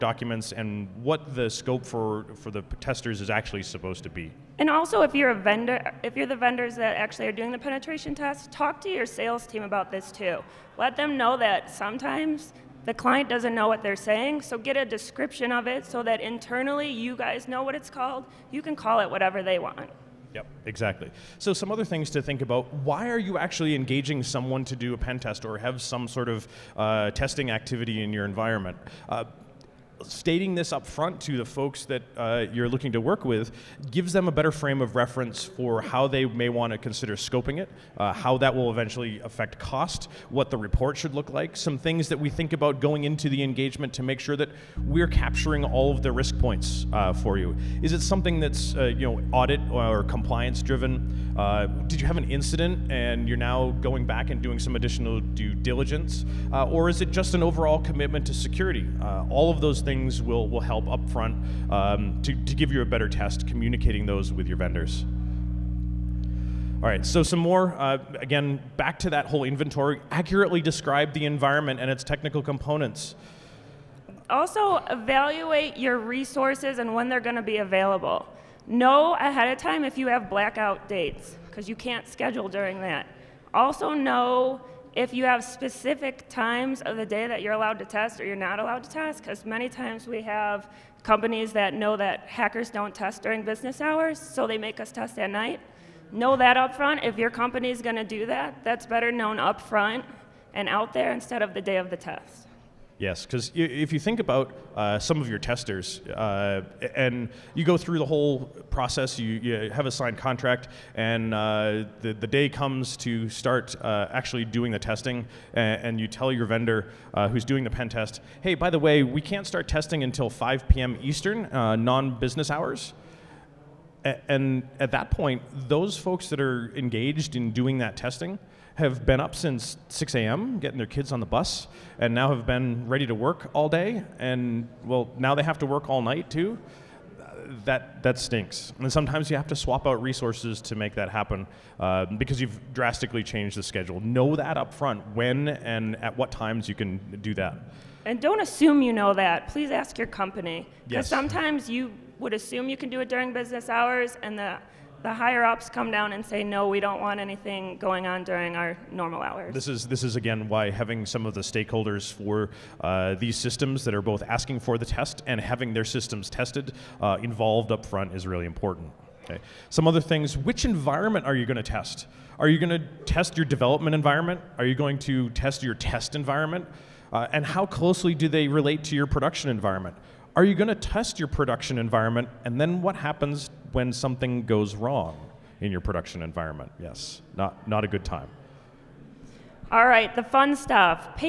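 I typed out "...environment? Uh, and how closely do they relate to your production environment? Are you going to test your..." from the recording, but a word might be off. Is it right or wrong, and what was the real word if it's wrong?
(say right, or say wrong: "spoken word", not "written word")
right.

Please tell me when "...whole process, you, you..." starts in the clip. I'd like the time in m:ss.
1:48.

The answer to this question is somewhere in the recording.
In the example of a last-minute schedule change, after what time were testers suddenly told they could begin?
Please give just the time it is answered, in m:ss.
2:00.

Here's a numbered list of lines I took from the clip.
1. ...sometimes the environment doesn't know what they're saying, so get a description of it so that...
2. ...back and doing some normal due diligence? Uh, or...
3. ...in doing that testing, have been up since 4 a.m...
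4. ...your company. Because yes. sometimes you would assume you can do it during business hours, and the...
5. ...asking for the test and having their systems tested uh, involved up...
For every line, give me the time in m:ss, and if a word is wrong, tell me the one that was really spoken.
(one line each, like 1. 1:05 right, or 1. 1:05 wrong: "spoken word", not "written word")
1. 0:11 wrong: "client", not "environment"
2. 0:54 wrong: "additional", not "normal"
3. 2:07 wrong: "6", not "4"
4. 2:29 right
5. 2:44 right.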